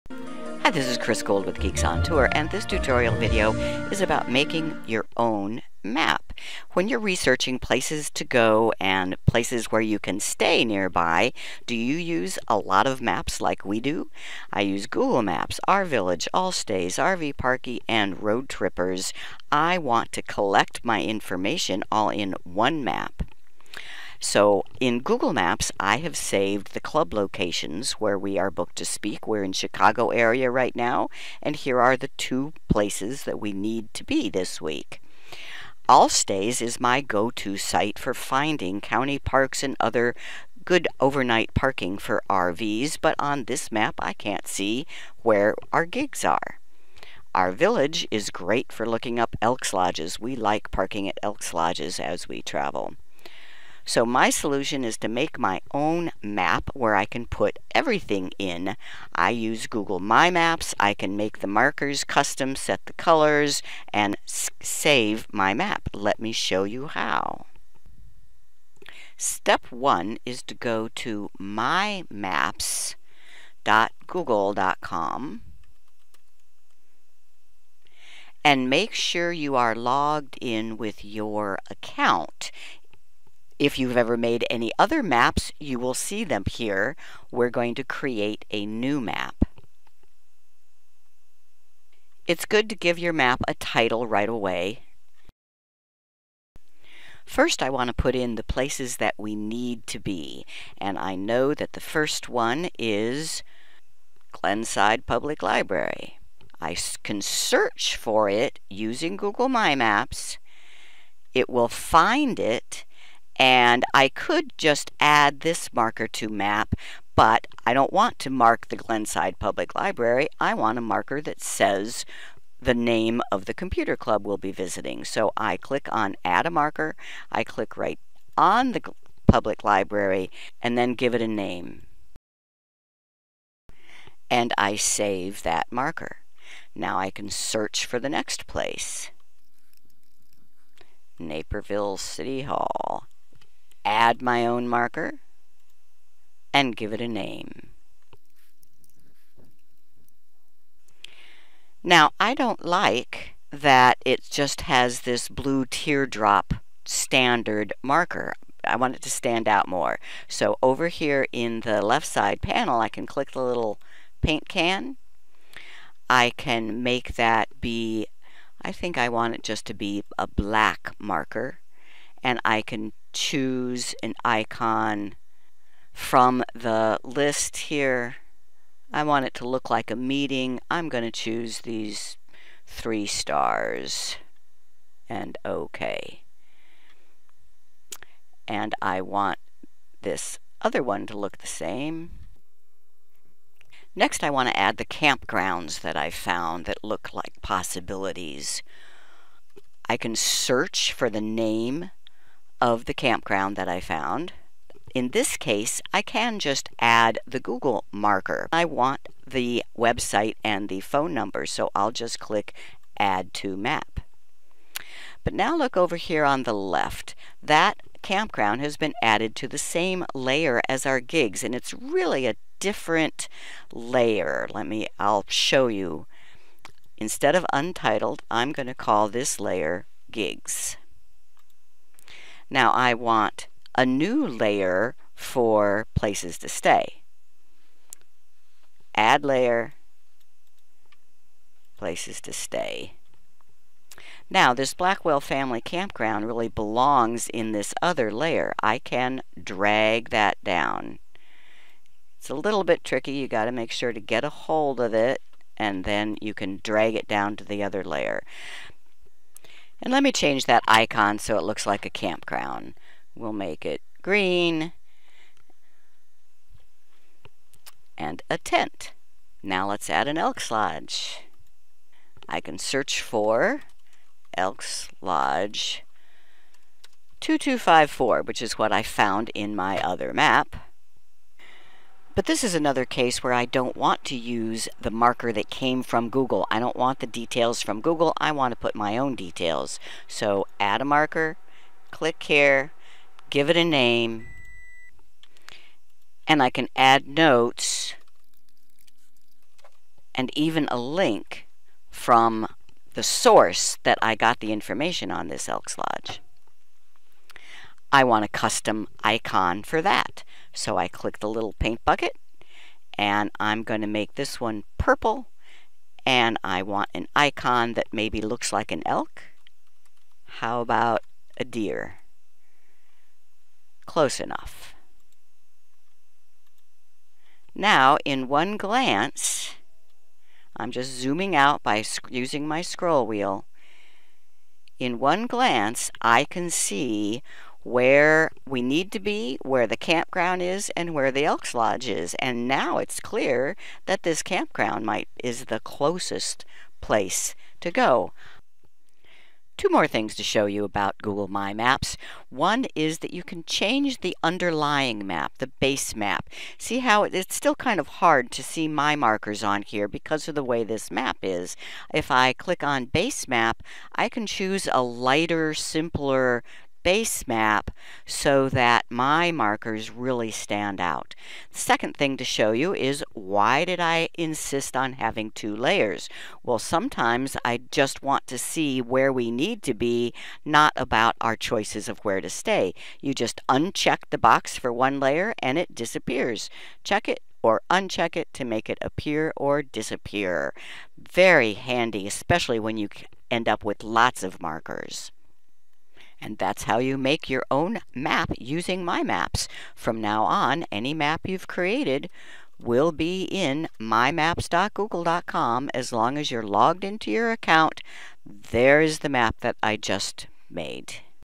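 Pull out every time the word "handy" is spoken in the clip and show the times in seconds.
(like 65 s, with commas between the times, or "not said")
391 s.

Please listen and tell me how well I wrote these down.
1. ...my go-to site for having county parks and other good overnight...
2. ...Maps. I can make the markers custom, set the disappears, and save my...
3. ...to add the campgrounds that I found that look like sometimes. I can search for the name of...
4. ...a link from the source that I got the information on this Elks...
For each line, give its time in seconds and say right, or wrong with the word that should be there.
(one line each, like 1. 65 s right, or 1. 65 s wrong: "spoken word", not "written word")
1. 36 s wrong: "finding", not "having"
2. 60 s wrong: "colors", not "disappears"
3. 194 s wrong: "possibilities", not "sometimes"
4. 300 s right.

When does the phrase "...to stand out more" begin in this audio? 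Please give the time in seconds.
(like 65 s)
159 s.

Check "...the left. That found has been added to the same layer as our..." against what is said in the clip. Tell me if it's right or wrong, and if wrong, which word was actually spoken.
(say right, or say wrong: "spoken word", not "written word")
wrong: "campground", not "found".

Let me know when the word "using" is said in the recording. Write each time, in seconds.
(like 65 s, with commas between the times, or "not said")
108 s, 332 s, 398 s.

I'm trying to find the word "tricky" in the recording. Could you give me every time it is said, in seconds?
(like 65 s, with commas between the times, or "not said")
252 s.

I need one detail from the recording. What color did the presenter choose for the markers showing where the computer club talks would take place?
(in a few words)
Black.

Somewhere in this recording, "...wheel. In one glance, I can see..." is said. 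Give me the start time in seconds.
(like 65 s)
333 s.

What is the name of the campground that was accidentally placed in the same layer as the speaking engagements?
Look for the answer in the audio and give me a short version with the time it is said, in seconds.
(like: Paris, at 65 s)
Blackwell Family Campground, at 244 s.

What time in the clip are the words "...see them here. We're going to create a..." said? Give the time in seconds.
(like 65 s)
85 s.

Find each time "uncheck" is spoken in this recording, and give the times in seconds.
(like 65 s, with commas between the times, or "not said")
383 s, 387 s.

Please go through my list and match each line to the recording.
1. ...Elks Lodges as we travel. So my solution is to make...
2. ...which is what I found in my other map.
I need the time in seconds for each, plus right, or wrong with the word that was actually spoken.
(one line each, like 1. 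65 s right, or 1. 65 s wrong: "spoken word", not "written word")
1. 51 s right
2. 278 s right.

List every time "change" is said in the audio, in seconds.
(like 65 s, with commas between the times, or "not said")
260 s, 353 s.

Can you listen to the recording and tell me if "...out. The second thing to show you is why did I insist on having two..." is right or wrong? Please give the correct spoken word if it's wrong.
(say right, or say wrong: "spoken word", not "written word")
right.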